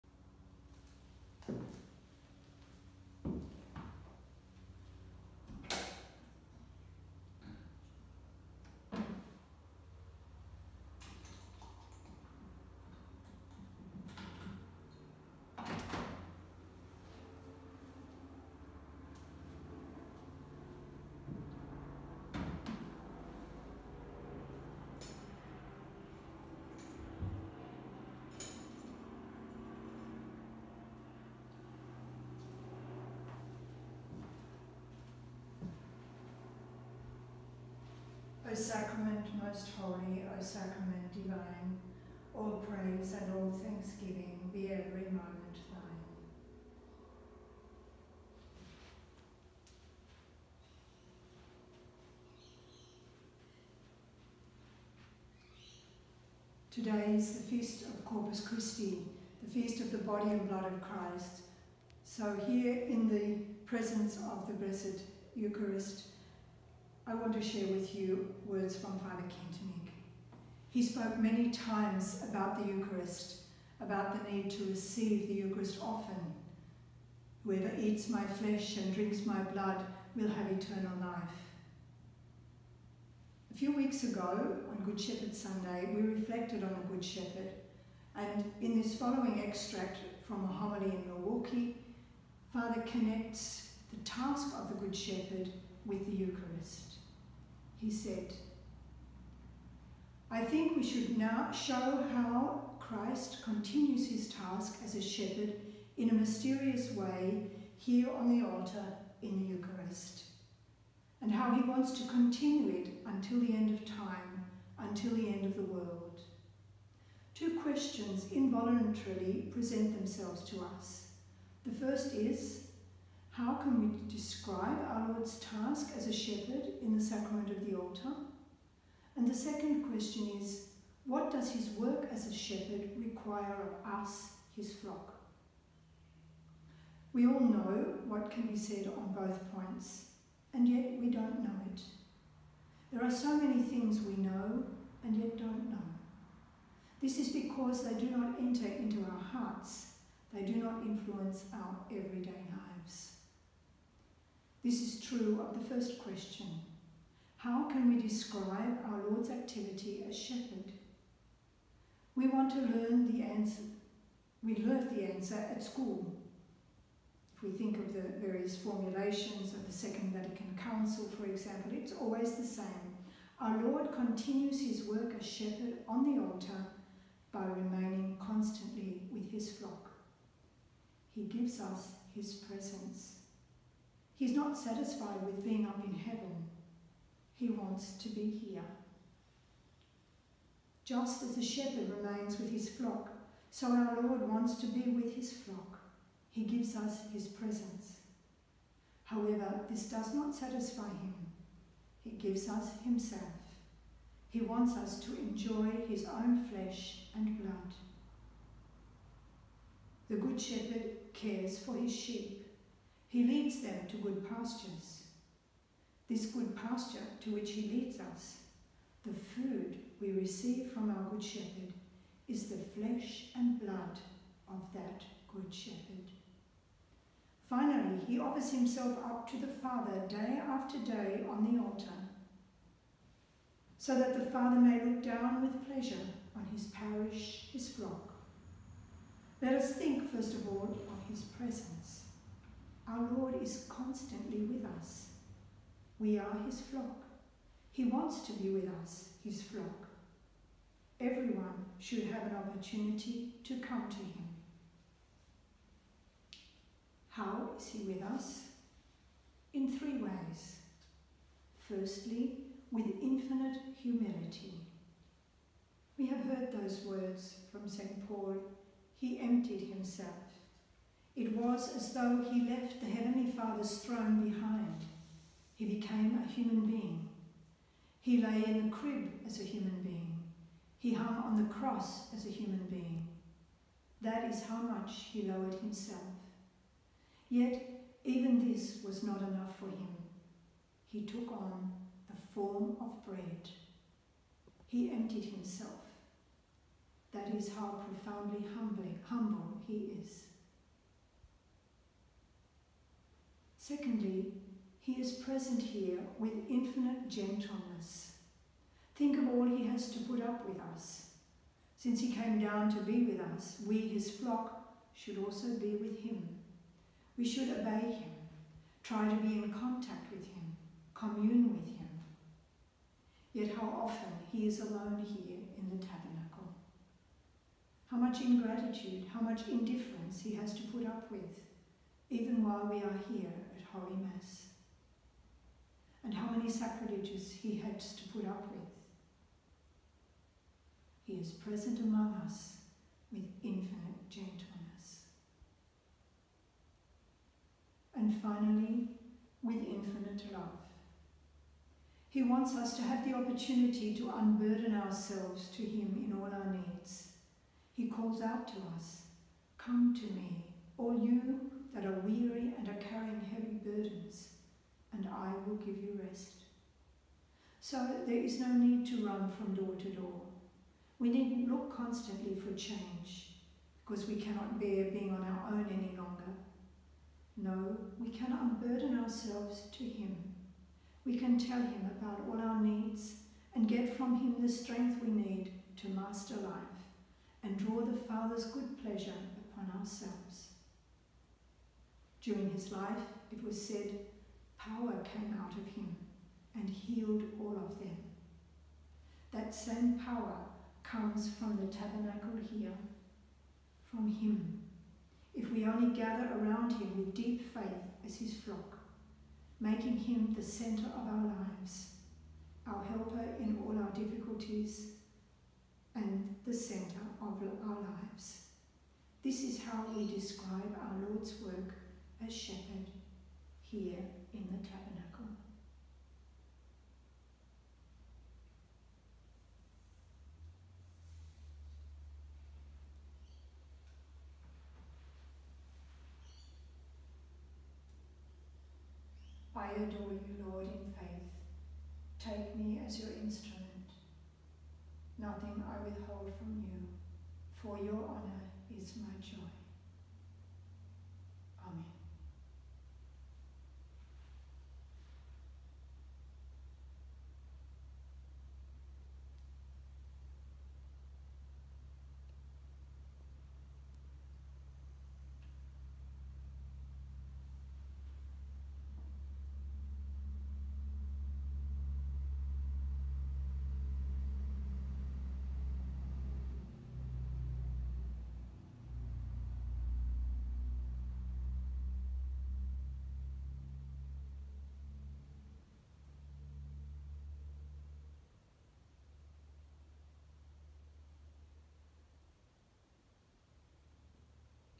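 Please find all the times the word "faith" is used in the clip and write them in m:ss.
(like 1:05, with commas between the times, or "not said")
6:47, 7:20.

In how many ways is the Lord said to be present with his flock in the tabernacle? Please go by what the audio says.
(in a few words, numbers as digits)
3.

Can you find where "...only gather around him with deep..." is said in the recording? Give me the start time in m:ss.
6:45.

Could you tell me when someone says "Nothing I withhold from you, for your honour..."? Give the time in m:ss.
7:25.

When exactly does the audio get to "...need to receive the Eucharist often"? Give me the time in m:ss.
1:14.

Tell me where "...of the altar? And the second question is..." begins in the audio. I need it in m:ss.
2:07.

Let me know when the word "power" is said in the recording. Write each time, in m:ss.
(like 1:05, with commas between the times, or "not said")
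6:34, 6:40.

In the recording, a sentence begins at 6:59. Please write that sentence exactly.
This is how we describe our Lord's work as shepherd here in the tabernacle.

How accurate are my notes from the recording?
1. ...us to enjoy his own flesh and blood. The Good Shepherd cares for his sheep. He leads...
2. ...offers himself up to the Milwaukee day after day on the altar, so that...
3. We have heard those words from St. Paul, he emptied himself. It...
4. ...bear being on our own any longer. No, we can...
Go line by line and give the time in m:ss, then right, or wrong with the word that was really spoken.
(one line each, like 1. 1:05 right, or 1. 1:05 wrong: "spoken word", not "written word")
1. 3:24 right
2. 3:48 wrong: "Father", not "Milwaukee"
3. 4:25 right
4. 6:14 right.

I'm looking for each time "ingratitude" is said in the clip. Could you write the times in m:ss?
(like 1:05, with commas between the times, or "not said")
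5:28.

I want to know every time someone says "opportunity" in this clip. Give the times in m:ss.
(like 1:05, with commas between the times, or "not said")
4:12, 5:53.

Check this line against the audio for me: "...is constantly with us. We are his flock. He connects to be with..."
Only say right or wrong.
wrong.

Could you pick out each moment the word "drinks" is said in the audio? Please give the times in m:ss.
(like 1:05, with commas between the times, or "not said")
1:18.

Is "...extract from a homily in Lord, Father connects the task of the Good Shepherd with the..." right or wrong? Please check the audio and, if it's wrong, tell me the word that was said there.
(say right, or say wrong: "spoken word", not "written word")
wrong: "Milwaukee", not "Lord".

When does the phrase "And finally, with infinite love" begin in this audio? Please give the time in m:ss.
5:47.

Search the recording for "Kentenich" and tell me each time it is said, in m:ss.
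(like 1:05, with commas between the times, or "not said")
1:09.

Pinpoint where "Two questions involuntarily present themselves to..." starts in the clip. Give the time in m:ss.
1:57.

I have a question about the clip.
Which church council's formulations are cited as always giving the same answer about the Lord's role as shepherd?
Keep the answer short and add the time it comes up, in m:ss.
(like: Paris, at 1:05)
Second Vatican Council, at 2:49.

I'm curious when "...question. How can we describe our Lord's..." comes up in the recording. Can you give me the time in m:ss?
2:35.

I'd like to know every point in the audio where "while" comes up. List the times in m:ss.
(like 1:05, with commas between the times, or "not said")
5:32.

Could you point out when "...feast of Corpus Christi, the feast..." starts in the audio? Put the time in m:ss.
0:57.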